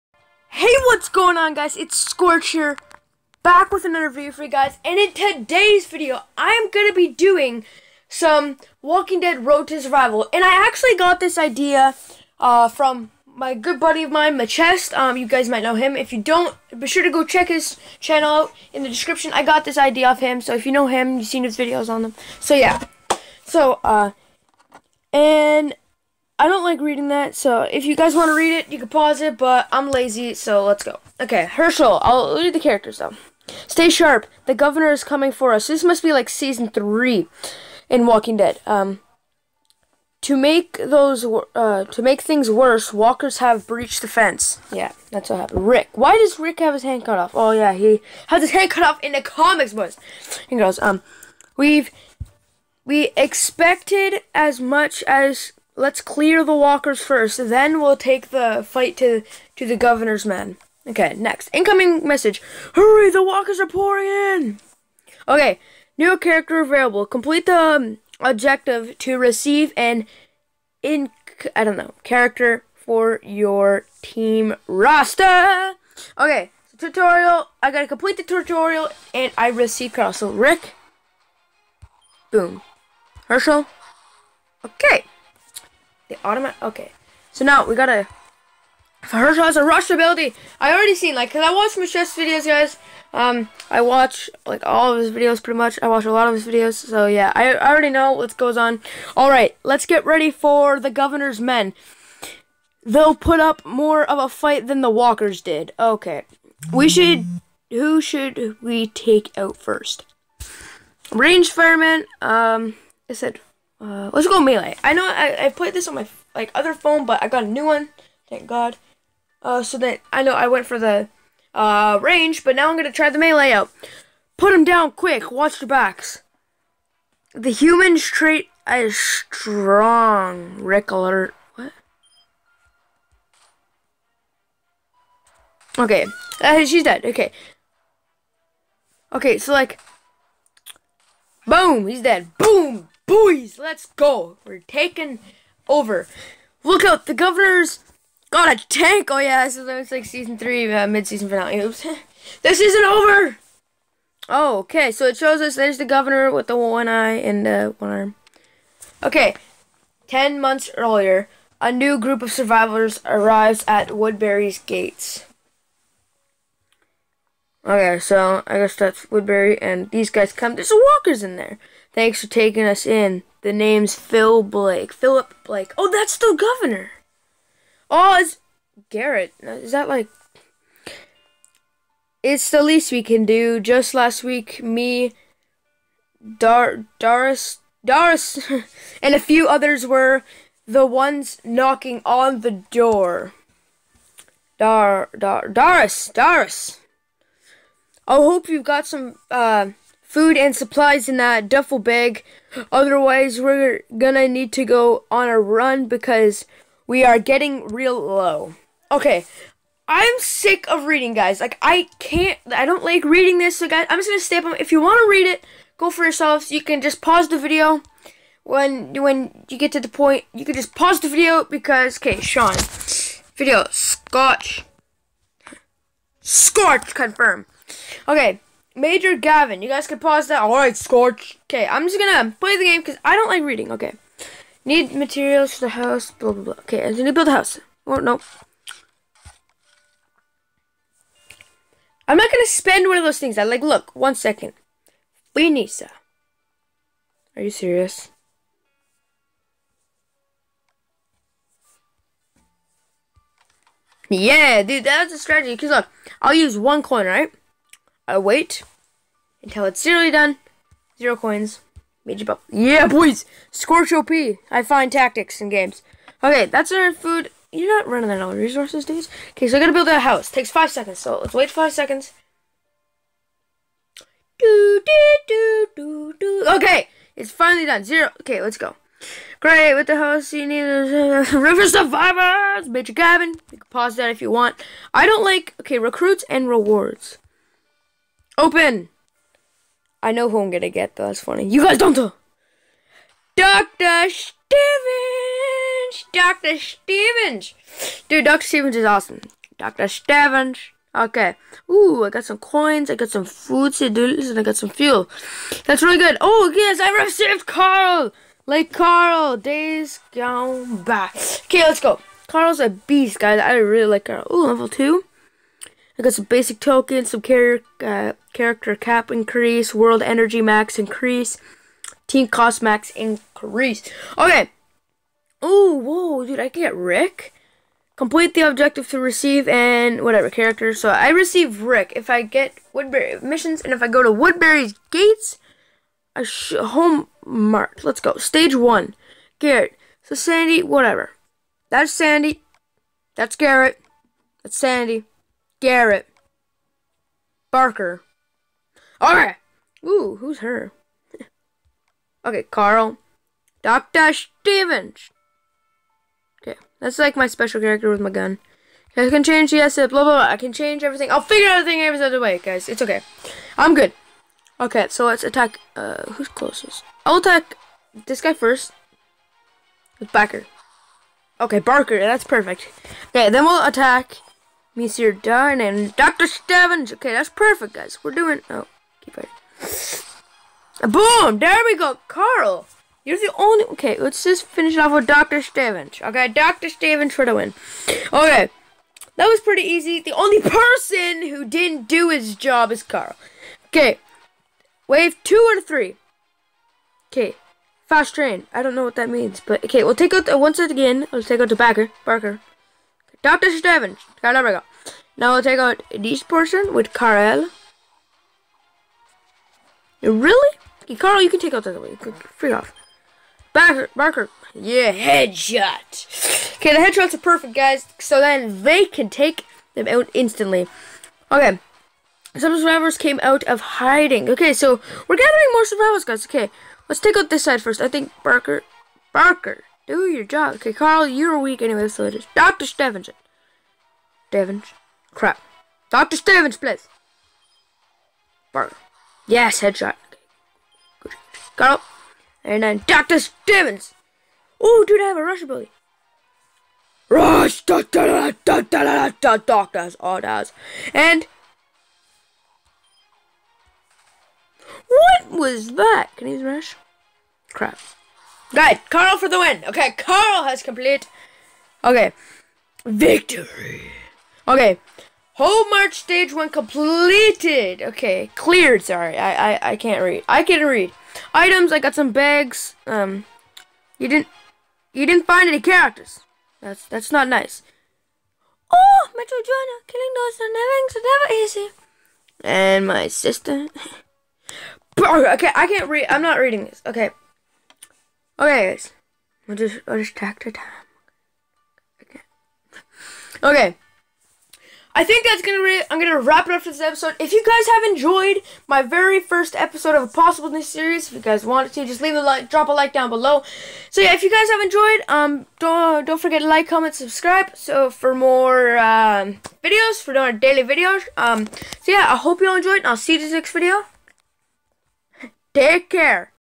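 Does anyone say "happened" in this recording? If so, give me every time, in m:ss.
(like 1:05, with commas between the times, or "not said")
0:45.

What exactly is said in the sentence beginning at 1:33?
Um, I watch like all of his videos pretty much.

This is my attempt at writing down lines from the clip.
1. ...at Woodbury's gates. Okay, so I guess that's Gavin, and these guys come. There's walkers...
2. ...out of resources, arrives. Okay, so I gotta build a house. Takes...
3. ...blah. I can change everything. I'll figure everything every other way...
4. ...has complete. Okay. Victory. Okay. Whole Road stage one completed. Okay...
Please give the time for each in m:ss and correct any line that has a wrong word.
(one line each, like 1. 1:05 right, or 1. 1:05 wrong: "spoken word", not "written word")
1. 2:43 wrong: "Woodbury", not "Gavin"
2. 4:28 wrong: "dudes", not "arrives"
3. 6:00 right
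4. 7:40 wrong: "March", not "Road".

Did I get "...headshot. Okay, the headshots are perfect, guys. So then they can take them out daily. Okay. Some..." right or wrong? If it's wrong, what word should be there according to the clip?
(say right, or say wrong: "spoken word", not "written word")
wrong: "instantly", not "daily".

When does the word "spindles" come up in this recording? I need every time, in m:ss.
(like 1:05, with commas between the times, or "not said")
not said.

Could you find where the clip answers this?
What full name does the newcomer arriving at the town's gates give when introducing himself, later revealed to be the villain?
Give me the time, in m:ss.
2:54.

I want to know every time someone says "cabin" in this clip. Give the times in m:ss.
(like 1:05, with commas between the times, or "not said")
4:42.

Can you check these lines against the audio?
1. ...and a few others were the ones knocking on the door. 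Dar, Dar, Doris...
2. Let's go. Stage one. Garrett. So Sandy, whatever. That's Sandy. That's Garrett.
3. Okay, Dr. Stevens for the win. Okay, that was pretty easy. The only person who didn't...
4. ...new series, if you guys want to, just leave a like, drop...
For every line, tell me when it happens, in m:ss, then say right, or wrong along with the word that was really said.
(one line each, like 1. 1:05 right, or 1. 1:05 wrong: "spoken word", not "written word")
1. 3:09 right
2. 5:37 right
3. 6:26 right
4. 8:20 right.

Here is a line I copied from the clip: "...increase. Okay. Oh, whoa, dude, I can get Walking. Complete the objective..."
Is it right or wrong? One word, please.
wrong.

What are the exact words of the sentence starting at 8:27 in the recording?
So for more um, videos, for more daily videos.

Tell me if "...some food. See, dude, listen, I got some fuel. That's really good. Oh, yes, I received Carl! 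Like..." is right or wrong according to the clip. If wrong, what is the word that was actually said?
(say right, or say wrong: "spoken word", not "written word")
right.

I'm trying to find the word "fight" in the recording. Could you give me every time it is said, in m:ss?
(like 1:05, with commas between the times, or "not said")
0:58, 1:44.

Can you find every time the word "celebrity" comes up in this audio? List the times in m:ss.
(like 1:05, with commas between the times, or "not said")
not said.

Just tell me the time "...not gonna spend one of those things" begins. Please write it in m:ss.
4:02.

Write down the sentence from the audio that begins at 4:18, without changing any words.
I uh, wait until it's nearly done.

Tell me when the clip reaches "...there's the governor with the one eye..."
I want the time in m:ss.
2:35.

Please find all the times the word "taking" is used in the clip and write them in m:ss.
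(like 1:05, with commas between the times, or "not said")
2:24, 2:52.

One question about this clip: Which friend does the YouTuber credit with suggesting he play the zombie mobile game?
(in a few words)
Matcheste.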